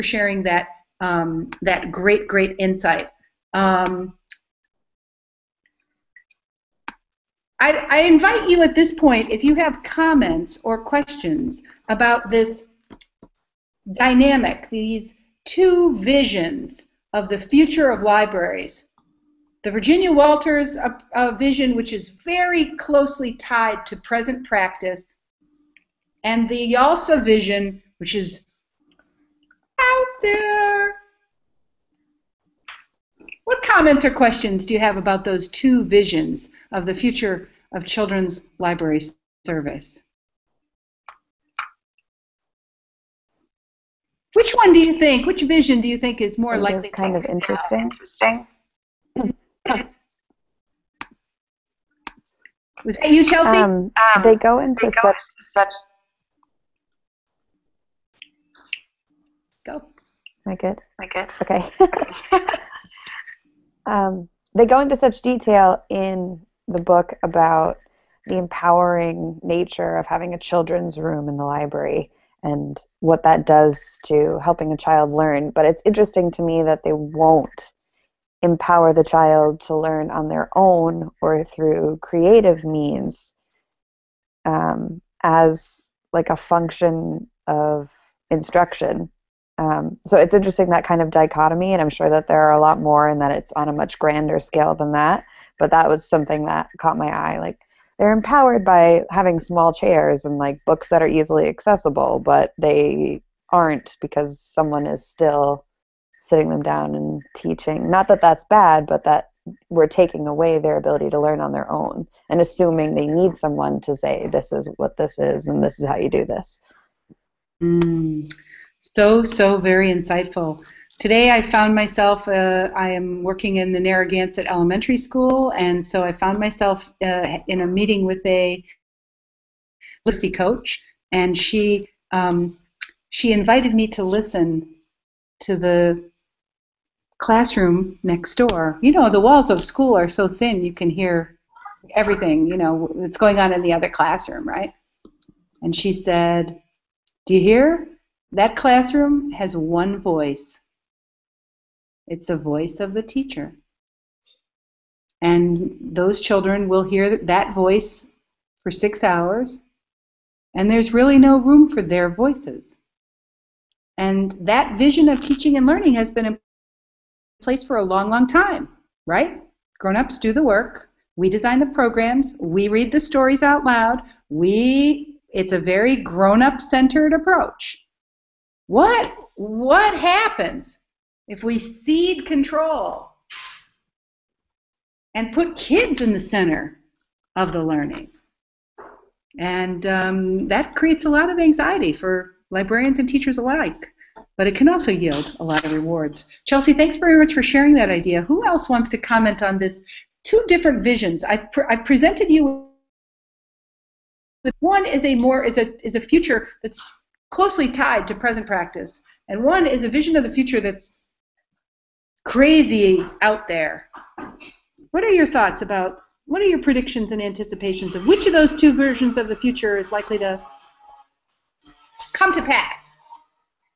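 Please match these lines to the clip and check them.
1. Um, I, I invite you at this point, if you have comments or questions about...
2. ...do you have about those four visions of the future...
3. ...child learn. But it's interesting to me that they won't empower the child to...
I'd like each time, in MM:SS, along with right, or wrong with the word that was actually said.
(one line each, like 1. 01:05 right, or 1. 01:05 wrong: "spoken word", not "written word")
1. 00:03 right
2. 00:34 wrong: "two", not "four"
3. 01:14 right.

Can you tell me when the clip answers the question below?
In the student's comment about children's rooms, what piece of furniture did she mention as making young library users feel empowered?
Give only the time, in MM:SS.
01:39.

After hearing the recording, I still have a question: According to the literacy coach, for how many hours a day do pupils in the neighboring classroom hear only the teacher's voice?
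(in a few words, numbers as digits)
6.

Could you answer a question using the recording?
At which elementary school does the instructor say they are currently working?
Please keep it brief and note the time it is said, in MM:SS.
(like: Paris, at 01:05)
Narragansett Elementary School, at 02:03.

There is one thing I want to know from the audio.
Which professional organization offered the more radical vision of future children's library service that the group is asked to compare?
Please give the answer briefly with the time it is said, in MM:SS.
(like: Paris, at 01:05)
YALSA, at 00:26.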